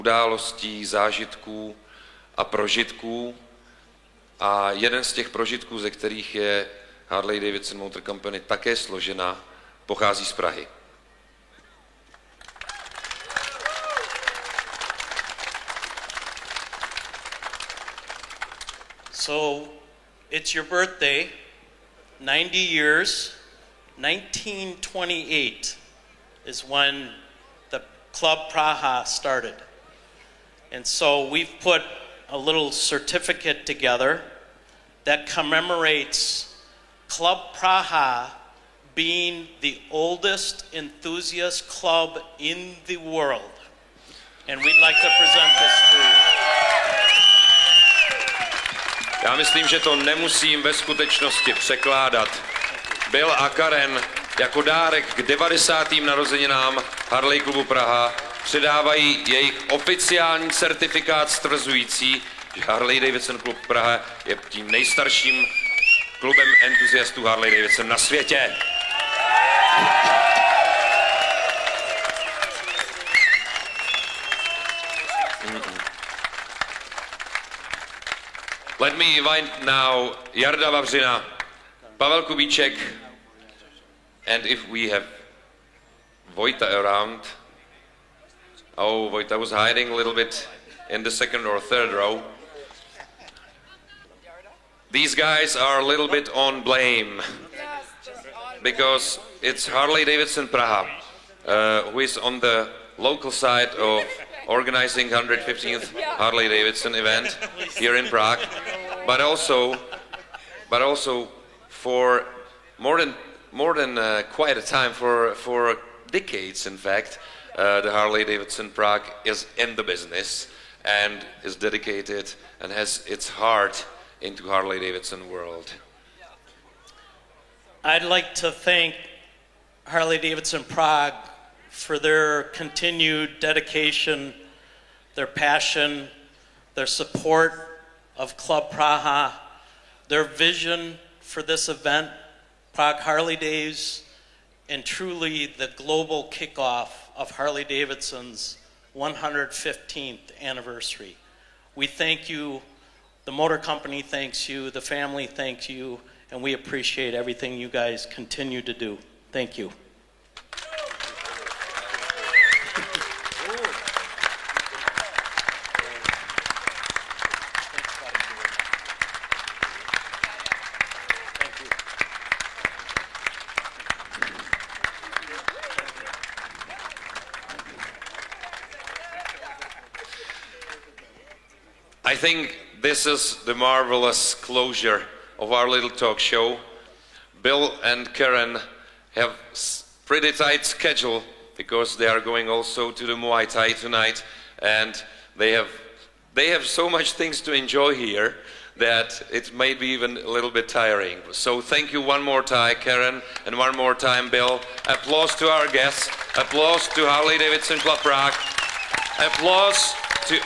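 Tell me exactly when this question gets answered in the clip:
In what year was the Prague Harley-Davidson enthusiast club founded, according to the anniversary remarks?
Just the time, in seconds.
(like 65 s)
23 s.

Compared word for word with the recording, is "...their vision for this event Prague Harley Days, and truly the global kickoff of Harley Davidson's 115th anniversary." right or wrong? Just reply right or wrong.
right.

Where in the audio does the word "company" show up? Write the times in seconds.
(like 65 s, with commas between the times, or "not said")
8 s, 153 s.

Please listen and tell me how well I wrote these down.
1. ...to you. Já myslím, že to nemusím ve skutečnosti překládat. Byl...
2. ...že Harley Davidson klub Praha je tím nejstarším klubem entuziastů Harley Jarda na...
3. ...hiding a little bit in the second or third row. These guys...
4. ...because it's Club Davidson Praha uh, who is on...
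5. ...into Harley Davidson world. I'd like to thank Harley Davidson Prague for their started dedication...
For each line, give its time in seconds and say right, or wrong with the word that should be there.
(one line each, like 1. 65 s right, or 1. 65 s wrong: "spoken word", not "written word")
1. 45 s right
2. 62 s wrong: "Davidson", not "Jarda"
3. 89 s right
4. 98 s wrong: "Harley", not "Club"
5. 124 s wrong: "continued", not "started".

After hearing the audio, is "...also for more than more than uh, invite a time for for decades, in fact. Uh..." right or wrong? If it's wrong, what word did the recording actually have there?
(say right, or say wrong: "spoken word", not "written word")
wrong: "quite", not "invite".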